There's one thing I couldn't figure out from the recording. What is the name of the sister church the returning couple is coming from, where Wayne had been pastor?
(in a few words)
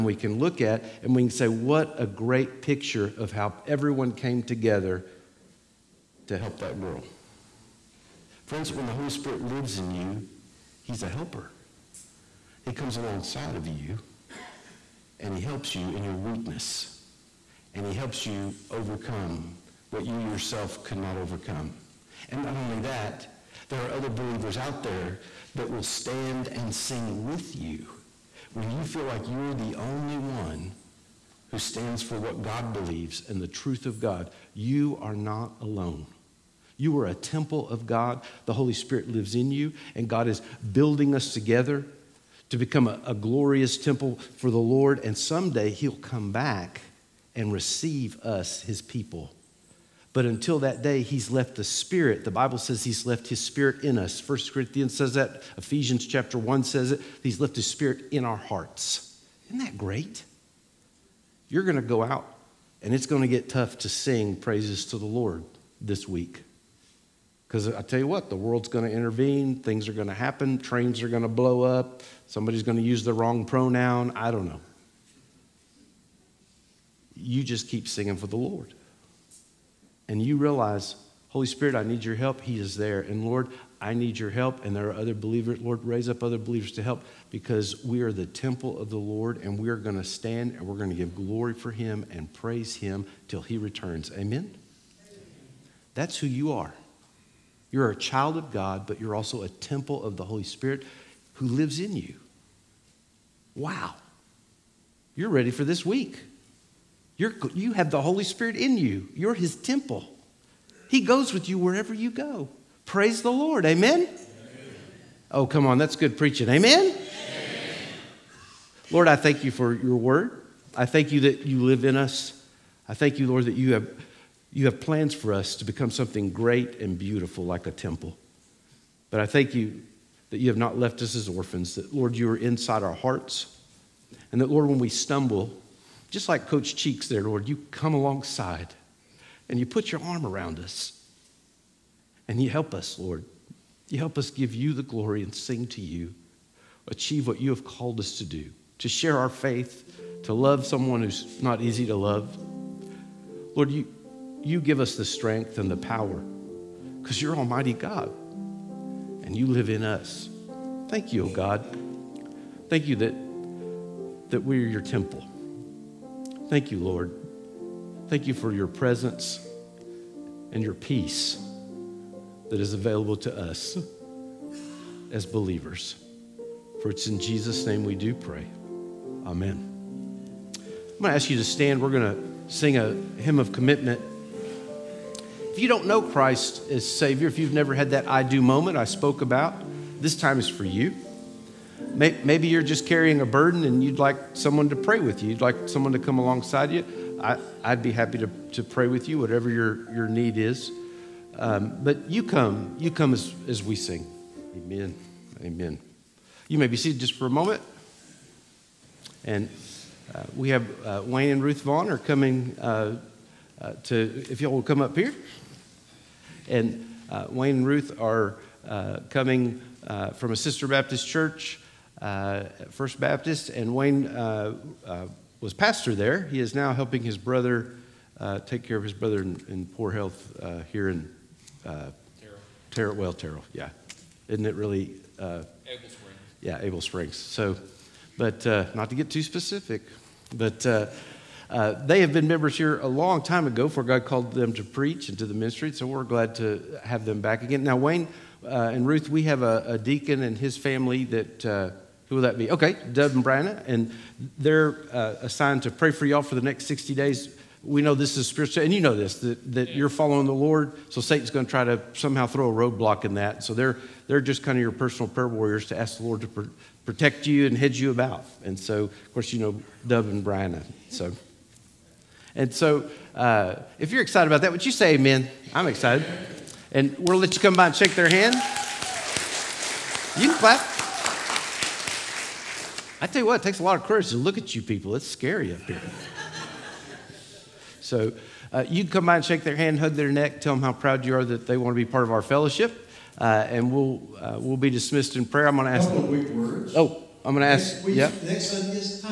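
First Baptist.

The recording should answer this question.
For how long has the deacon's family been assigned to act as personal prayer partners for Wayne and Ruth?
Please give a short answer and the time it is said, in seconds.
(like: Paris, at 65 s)
60 days, at 256 s.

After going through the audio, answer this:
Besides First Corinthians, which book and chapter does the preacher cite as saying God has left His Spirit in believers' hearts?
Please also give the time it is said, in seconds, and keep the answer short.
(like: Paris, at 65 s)
Ephesians chapter 1, at 55 s.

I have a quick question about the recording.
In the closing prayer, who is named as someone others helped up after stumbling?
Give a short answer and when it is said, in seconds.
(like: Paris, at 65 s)
Coach Cheeks, at 136 s.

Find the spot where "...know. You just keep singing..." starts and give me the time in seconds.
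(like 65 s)
74 s.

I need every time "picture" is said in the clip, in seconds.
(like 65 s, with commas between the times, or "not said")
2 s.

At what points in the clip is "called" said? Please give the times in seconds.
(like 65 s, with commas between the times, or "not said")
147 s, 244 s.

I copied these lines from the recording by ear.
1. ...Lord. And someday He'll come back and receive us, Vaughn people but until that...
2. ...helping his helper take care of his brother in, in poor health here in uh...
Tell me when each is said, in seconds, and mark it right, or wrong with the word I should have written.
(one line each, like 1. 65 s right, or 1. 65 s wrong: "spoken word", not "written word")
1. 44 s wrong: "His", not "Vaughn"
2. 226 s wrong: "brother", not "helper".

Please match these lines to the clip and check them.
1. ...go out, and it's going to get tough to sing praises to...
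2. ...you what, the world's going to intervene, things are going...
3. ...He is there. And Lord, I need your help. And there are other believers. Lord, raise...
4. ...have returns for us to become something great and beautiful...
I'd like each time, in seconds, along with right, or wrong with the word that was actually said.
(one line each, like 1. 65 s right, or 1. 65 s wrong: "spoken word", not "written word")
1. 61 s right
2. 67 s right
3. 82 s right
4. 124 s wrong: "plans", not "returns".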